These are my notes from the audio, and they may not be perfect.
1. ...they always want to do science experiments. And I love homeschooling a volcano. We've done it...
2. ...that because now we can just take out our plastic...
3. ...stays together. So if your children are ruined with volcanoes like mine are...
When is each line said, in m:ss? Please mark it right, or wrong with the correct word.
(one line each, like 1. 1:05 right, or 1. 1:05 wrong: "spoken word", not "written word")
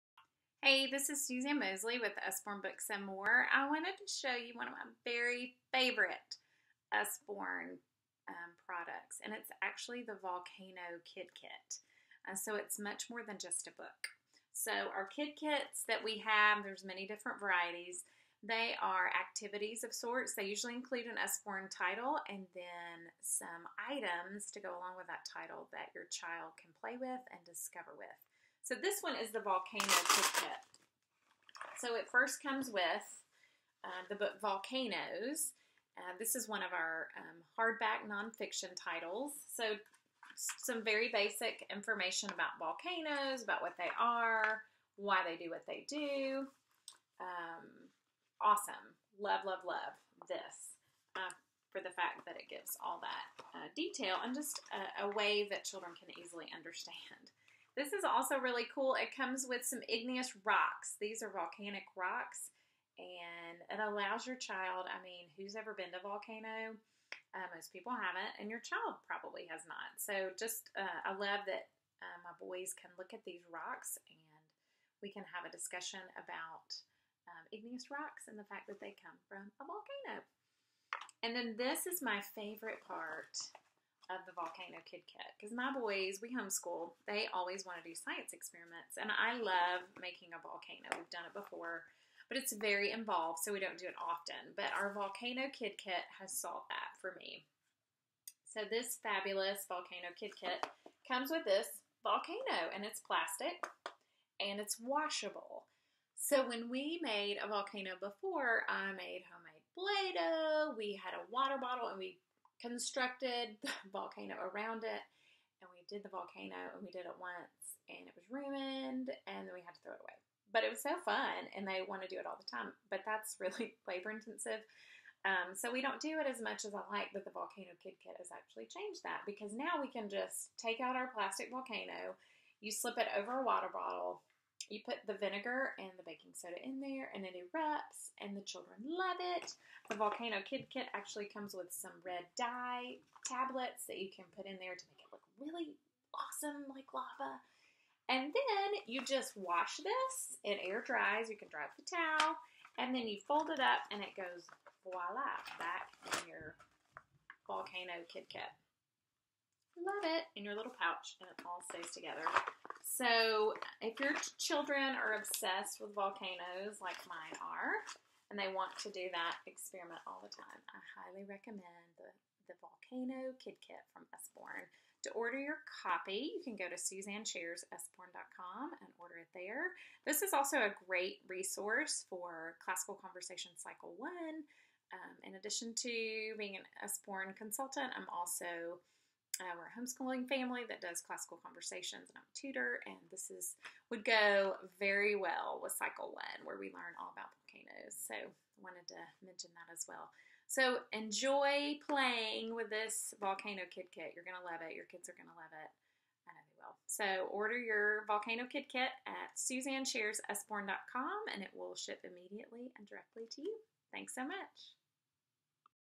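1. 1:27 wrong: "making", not "homeschooling"
2. 2:09 right
3. 2:41 wrong: "obsessed", not "ruined".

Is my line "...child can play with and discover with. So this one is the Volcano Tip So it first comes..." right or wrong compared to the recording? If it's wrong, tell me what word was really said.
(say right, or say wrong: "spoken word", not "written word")
right.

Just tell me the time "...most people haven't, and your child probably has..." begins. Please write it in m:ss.
1:07.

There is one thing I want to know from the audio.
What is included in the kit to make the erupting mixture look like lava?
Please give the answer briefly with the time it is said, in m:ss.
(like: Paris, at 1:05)
Red dye tablets, at 2:22.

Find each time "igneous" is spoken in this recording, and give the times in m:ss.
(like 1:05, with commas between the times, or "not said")
0:59, 1:17.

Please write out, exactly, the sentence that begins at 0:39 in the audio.
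So some very basic information about volcanoes, about what they are, why they do what they do.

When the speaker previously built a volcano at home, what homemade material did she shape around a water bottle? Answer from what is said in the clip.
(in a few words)
Play-Doh.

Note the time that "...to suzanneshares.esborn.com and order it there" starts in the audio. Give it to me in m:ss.
2:56.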